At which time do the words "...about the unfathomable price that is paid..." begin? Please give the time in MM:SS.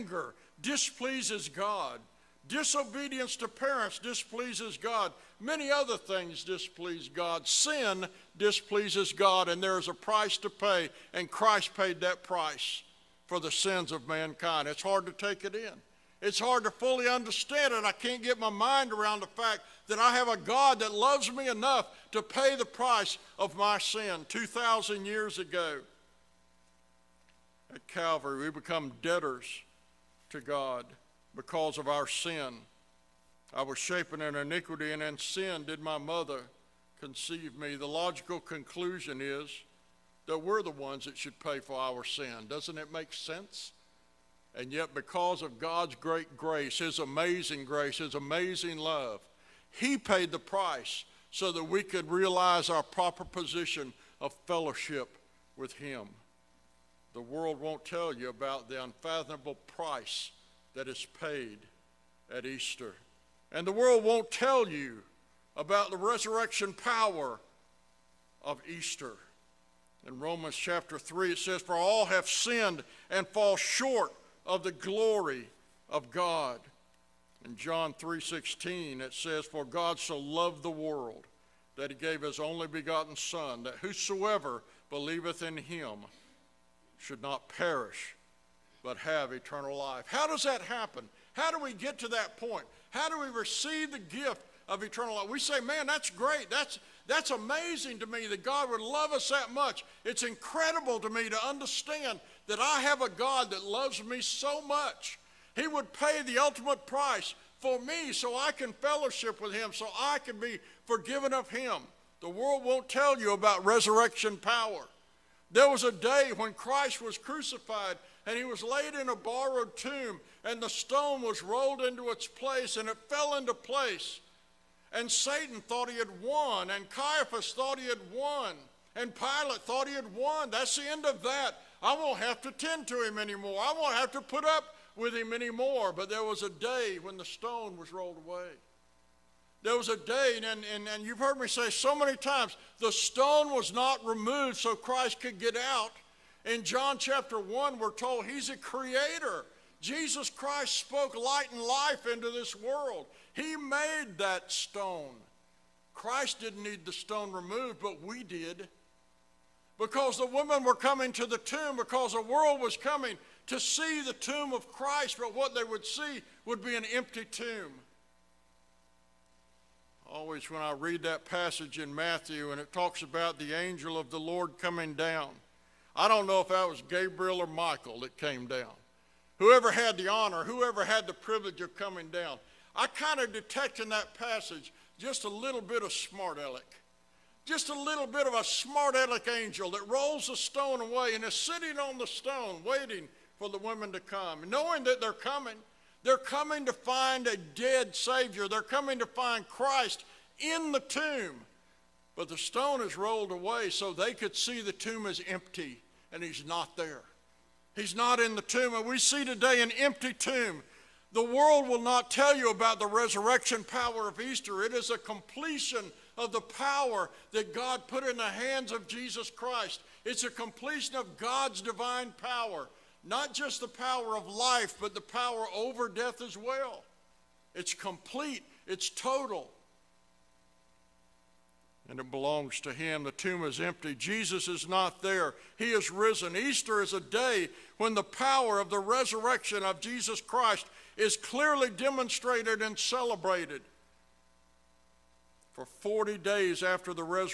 00:58.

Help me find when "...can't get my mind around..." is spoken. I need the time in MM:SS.
00:17.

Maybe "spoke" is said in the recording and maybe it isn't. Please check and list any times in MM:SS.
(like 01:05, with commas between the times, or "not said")
02:30.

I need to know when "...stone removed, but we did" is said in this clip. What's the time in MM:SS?
02:36.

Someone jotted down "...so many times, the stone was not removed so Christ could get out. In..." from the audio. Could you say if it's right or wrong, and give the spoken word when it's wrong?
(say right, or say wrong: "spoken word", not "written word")
right.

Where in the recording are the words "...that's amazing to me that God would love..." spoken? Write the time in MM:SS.
01:37.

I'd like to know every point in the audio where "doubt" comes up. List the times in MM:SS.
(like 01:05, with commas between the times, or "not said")
not said.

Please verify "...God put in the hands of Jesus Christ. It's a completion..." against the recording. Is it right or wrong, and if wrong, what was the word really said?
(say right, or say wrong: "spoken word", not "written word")
right.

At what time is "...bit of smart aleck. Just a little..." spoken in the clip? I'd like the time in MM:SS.
03:05.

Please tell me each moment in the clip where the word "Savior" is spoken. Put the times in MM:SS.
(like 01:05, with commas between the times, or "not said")
03:17.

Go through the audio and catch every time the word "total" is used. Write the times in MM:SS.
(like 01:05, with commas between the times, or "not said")
03:48.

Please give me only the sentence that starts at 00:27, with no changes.
At Calvary, we become debtors to God because of our sin.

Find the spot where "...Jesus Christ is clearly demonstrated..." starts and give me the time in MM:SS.
03:59.